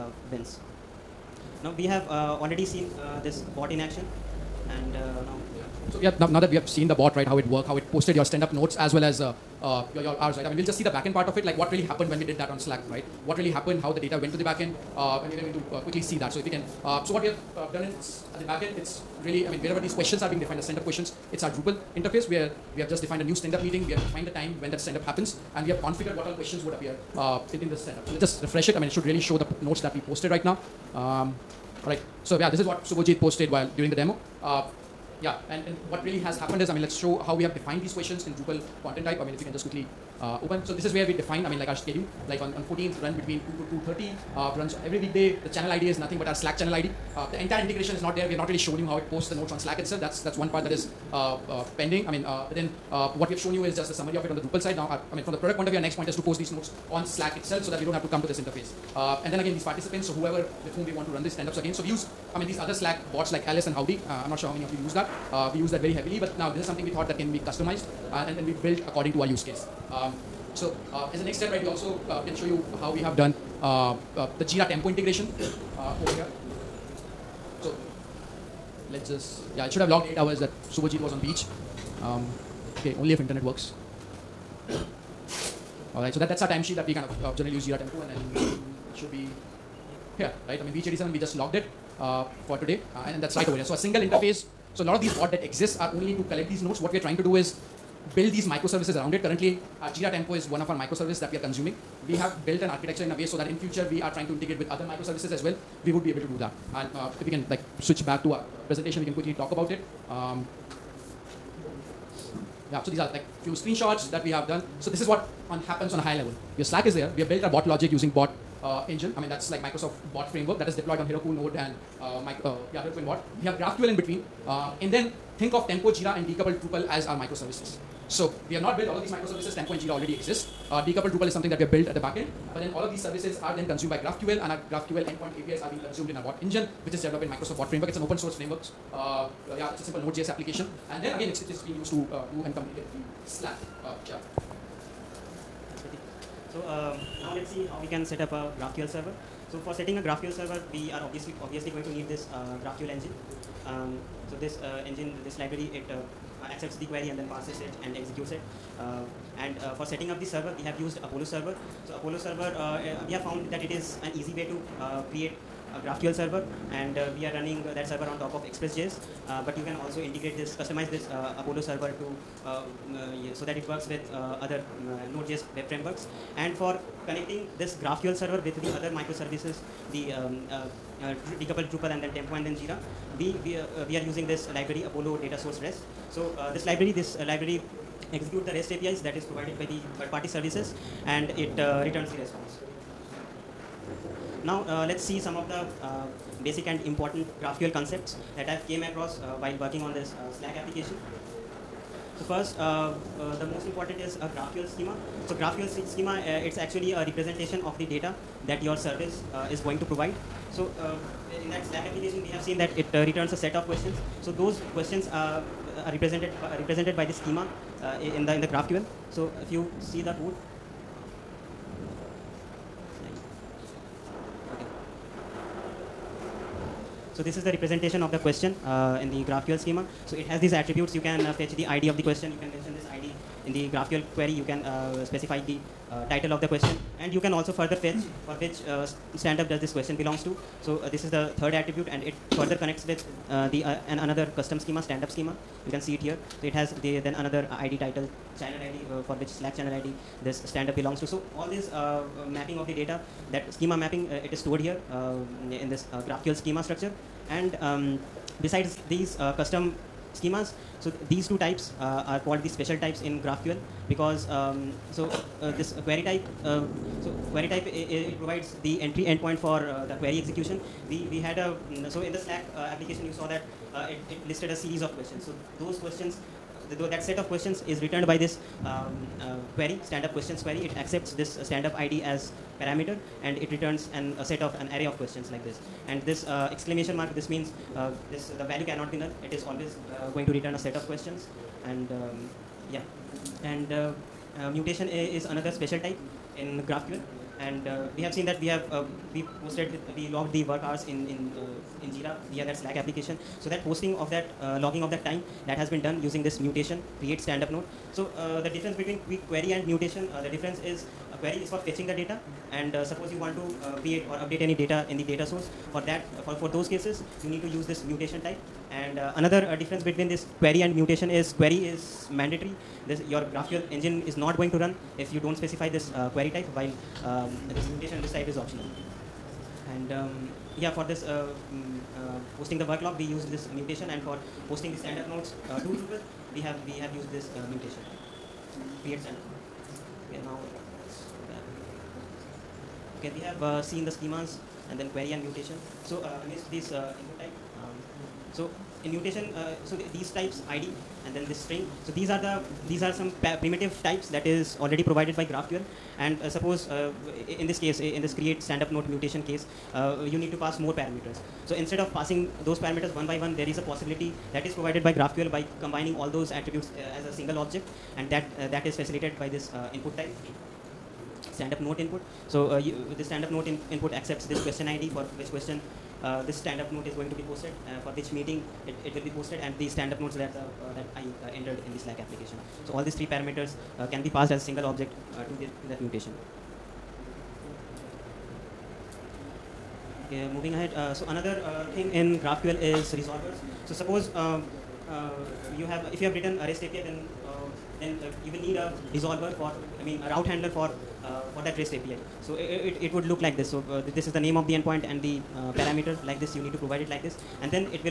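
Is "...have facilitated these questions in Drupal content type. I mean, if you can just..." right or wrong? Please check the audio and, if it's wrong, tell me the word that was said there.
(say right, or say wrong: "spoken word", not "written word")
wrong: "defined", not "facilitated".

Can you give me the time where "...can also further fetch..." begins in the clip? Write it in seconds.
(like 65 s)
237 s.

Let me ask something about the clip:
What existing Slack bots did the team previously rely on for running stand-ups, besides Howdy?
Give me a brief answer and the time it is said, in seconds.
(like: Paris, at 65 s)
Alice, at 63 s.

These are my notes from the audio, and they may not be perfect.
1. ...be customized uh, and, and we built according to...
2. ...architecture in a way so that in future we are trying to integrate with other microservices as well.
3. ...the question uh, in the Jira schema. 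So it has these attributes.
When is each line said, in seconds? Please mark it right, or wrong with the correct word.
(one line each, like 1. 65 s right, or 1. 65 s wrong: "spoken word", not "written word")
1. 67 s right
2. 102 s right
3. 228 s wrong: "GraphQL", not "Jira".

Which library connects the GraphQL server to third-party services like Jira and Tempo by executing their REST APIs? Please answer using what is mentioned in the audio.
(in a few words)
Apollo data source REST.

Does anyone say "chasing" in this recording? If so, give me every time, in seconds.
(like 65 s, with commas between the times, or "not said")
not said.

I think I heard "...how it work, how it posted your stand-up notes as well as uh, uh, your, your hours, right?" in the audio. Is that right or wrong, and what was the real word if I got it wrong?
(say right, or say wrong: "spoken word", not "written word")
right.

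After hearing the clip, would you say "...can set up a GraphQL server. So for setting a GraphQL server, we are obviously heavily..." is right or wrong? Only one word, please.
wrong.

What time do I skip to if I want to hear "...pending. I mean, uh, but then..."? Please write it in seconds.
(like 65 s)
51 s.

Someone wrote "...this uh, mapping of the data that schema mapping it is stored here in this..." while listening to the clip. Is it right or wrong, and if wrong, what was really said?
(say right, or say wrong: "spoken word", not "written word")
right.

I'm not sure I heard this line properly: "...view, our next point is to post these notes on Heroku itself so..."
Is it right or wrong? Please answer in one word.
wrong.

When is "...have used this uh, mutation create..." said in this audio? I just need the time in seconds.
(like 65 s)
336 s.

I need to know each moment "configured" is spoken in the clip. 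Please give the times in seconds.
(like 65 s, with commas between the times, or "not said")
25 s.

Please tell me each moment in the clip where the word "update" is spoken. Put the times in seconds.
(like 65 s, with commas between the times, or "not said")
314 s.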